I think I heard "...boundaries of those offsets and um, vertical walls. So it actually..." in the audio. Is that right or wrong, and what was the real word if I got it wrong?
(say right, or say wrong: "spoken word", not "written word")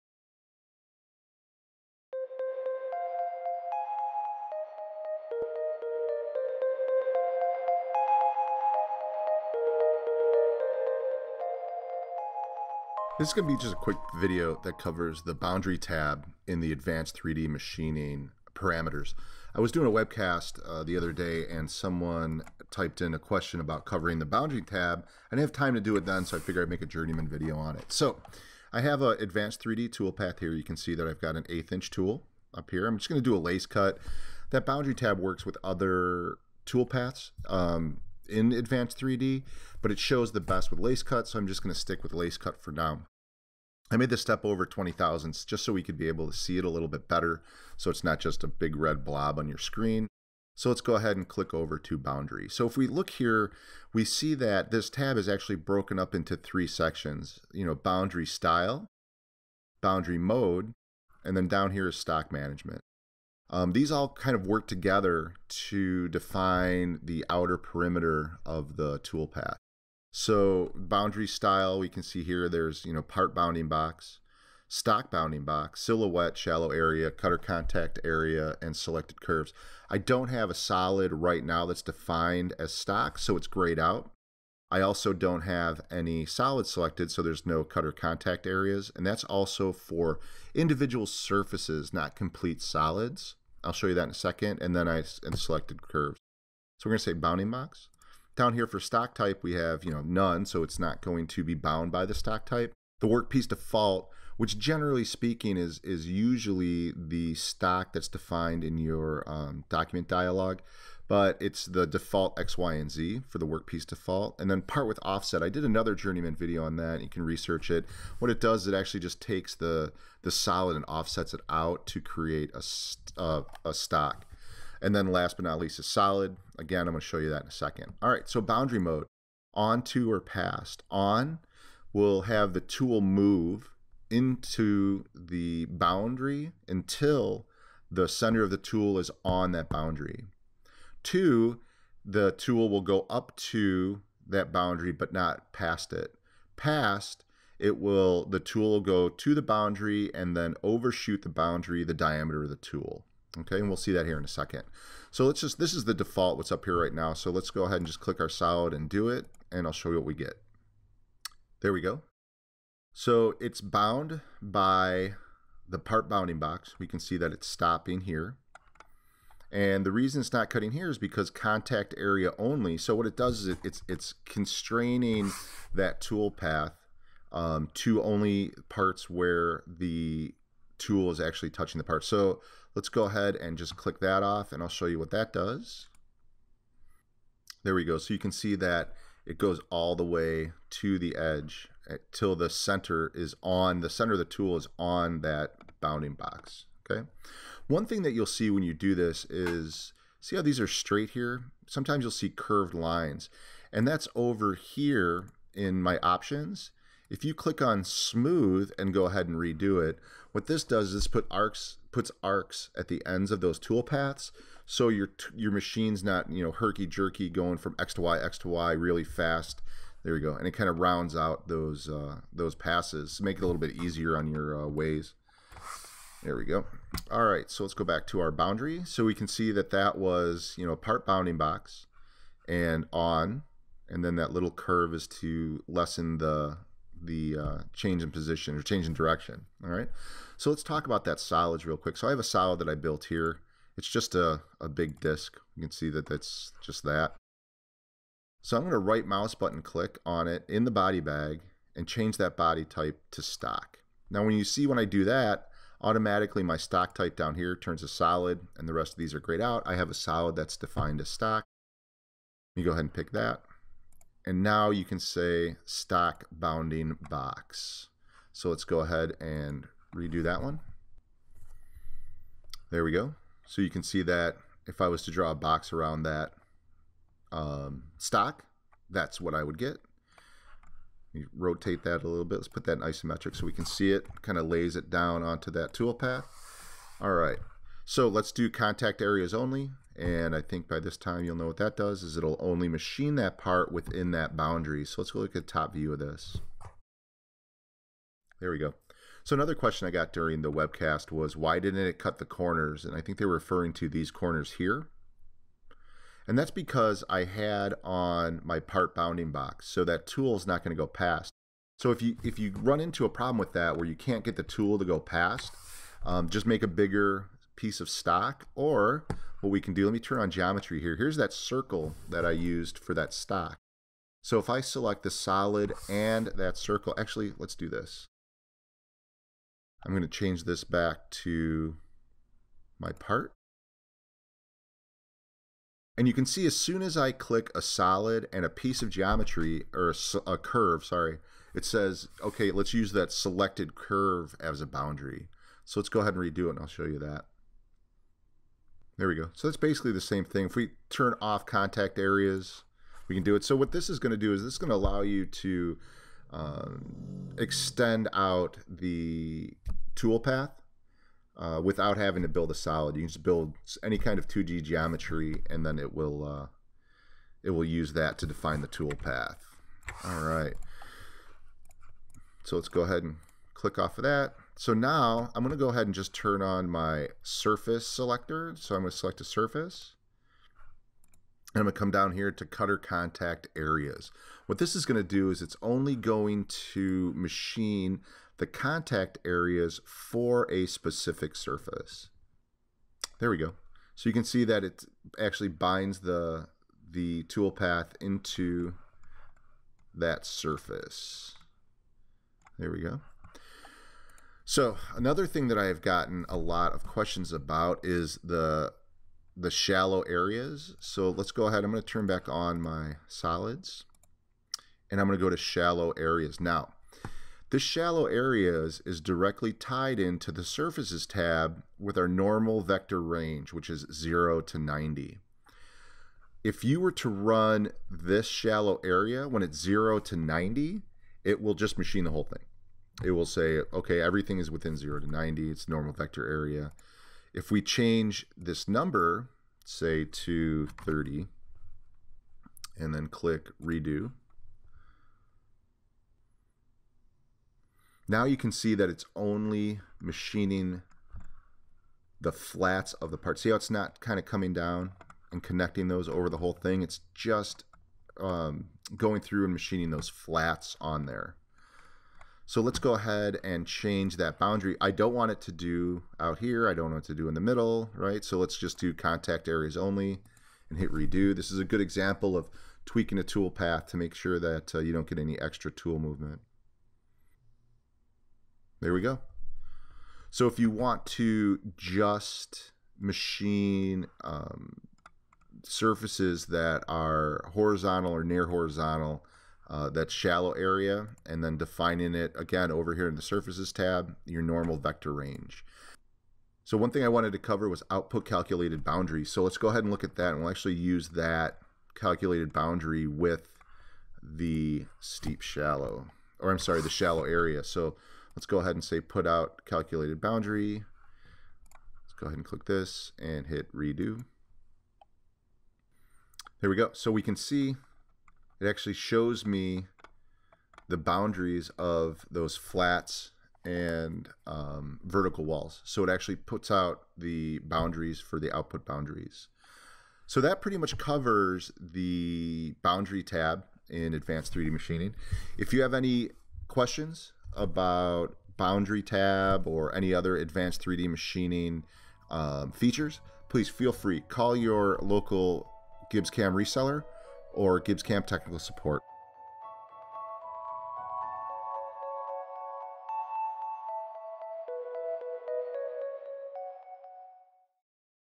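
wrong: "flats", not "offsets".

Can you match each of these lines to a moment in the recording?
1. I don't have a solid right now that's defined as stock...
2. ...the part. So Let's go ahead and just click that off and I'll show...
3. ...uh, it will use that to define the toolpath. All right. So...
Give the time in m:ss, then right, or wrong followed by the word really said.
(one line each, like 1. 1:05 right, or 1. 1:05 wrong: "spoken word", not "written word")
1. 1:19 right
2. 3:01 right
3. 6:06 right.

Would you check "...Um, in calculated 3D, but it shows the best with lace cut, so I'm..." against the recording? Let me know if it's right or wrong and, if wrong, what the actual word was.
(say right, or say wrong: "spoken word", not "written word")
wrong: "advanced", not "calculated".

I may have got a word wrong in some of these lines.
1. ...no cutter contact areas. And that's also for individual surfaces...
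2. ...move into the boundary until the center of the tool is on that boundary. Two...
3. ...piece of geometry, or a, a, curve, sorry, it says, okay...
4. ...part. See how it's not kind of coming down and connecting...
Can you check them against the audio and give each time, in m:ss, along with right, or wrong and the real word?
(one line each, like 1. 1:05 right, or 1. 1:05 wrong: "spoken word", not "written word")
1. 1:27 right
2. 2:13 right
3. 5:38 right
4. 7:33 right.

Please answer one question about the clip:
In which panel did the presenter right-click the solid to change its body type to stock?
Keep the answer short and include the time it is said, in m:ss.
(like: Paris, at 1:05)
Body bag, at 4:10.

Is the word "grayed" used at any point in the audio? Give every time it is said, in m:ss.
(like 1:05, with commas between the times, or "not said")
1:23, 4:19.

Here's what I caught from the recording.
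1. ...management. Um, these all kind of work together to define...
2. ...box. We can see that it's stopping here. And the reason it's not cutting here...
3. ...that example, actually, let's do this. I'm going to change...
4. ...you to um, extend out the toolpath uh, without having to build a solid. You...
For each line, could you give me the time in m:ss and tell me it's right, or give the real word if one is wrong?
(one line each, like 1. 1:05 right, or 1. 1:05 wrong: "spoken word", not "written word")
1. 1:02 right
2. 2:46 right
3. 5:26 wrong: "circle", not "example"
4. 5:55 right.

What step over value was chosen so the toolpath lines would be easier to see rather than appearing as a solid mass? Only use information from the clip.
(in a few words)
20 thousandths.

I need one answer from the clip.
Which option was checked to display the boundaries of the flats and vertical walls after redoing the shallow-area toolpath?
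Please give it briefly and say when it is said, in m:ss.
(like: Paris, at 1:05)
Output calculated boundary, at 8:17.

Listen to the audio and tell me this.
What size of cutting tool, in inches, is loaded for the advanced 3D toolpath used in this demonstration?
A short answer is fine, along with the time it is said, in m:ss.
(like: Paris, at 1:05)
1/8 inch, at 0:31.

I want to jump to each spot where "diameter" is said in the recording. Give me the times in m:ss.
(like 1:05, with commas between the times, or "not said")
2:31.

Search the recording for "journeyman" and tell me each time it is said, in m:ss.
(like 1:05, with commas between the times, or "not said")
0:26, 1:55.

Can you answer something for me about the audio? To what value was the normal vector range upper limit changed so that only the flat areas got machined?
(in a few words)
30.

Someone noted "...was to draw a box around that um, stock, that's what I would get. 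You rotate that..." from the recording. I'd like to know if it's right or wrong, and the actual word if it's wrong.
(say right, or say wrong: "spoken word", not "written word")
right.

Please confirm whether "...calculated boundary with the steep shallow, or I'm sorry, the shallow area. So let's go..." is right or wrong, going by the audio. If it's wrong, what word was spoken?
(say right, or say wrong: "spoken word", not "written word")
right.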